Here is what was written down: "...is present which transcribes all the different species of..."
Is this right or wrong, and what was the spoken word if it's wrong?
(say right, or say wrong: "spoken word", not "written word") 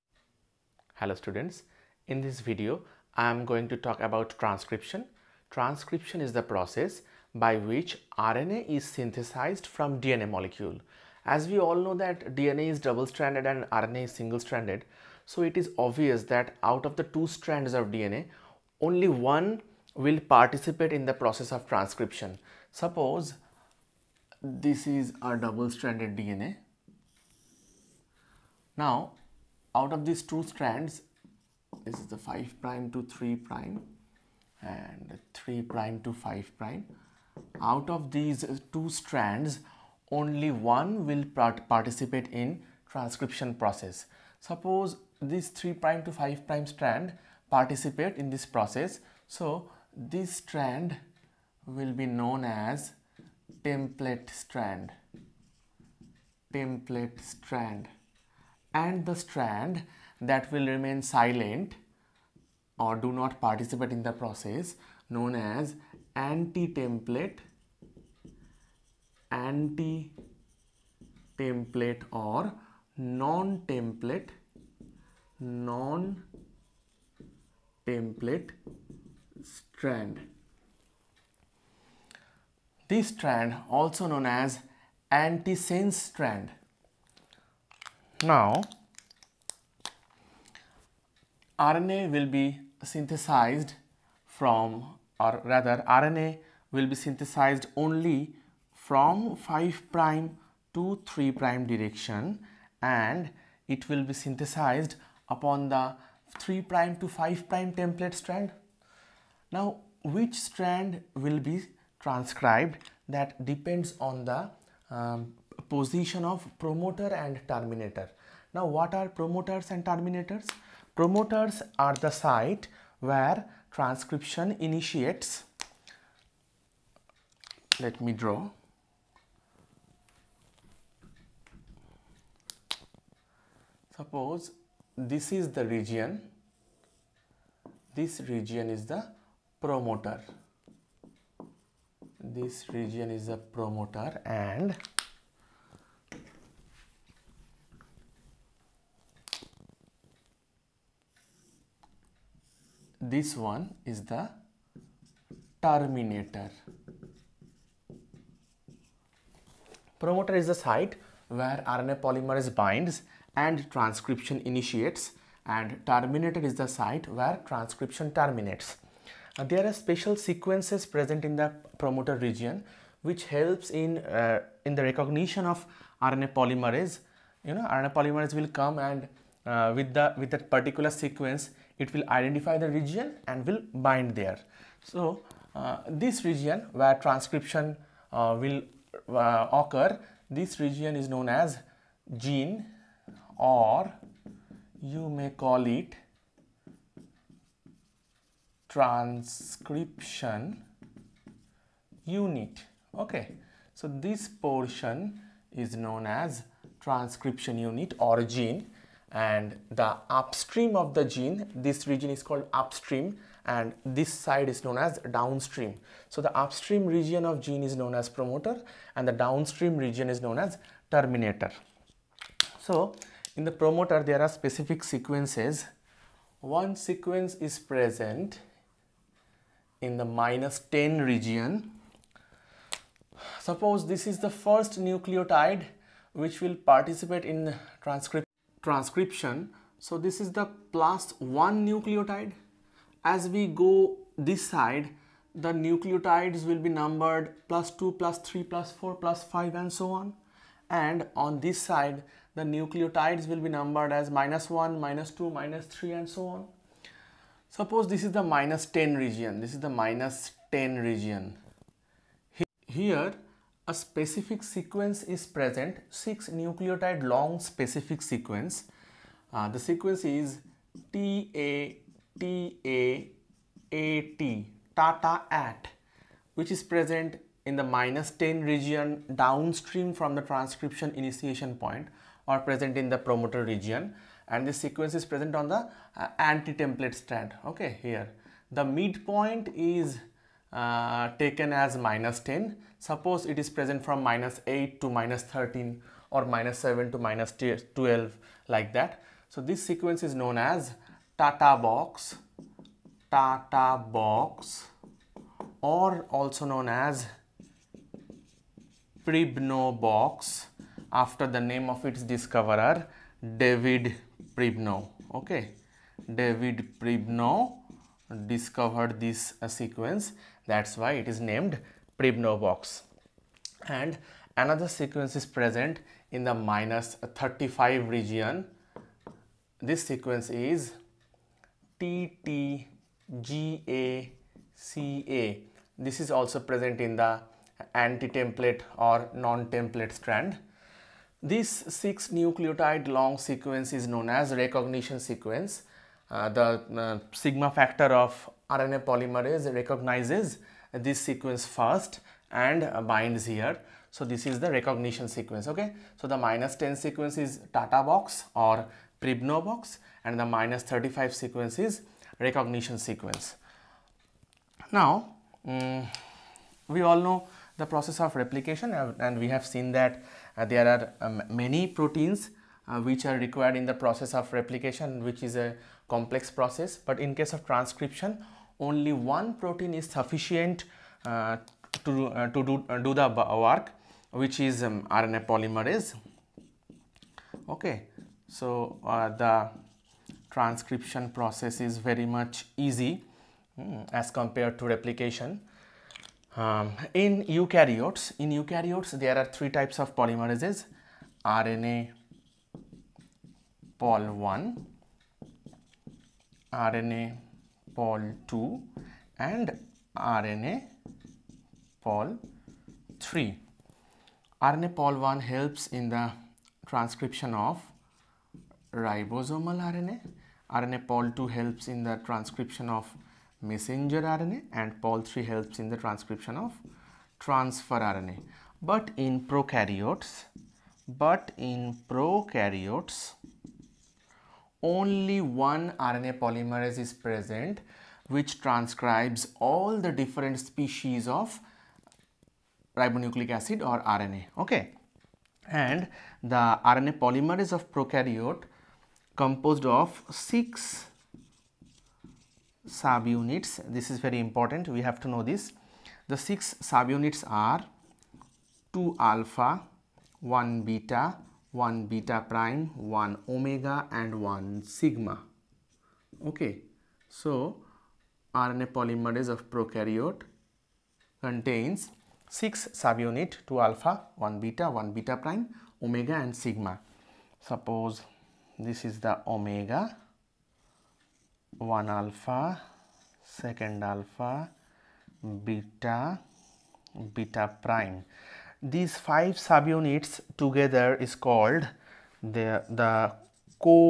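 right.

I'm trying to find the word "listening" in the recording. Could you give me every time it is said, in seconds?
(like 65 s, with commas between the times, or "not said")
not said.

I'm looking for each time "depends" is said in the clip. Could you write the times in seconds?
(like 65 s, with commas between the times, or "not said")
113 s.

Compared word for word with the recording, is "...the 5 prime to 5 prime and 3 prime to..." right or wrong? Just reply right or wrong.
wrong.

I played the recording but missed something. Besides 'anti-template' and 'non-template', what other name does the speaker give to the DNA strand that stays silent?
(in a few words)
antisense strand.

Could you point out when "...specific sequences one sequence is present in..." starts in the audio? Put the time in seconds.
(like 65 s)
224 s.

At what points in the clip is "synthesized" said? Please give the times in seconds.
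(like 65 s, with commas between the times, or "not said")
8 s, 92 s, 96 s, 104 s.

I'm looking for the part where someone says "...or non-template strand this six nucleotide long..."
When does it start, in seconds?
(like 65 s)
338 s.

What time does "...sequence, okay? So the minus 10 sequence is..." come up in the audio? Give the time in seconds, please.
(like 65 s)
355 s.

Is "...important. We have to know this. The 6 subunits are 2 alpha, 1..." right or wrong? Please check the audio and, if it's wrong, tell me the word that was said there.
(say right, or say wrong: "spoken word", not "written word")
right.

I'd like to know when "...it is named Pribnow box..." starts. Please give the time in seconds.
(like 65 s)
320 s.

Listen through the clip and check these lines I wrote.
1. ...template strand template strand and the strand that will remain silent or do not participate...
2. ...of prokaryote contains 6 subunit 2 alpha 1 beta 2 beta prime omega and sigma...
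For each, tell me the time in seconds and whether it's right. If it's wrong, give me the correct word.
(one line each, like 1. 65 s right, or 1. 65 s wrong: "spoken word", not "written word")
1. 53 s right
2. 469 s wrong: "1", not "2".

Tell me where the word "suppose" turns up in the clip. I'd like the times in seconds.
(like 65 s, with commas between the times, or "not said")
22 s, 44 s, 133 s, 233 s, 257 s, 292 s, 477 s.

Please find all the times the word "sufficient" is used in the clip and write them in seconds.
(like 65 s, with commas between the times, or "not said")
379 s.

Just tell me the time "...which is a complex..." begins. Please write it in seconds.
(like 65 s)
375 s.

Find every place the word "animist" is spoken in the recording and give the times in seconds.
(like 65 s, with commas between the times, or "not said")
not said.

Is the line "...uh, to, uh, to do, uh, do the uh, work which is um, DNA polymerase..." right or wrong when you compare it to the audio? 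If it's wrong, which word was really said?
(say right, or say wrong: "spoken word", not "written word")
wrong: "RNA", not "DNA".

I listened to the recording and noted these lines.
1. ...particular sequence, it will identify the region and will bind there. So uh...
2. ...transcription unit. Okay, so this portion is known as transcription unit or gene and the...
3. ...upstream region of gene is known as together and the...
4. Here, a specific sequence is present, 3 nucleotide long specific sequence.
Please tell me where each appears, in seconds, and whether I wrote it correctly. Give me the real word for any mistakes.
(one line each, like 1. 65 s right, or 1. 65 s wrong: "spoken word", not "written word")
1. 180 s right
2. 198 s right
3. 216 s wrong: "promoter", not "together"
4. 262 s wrong: "6", not "3".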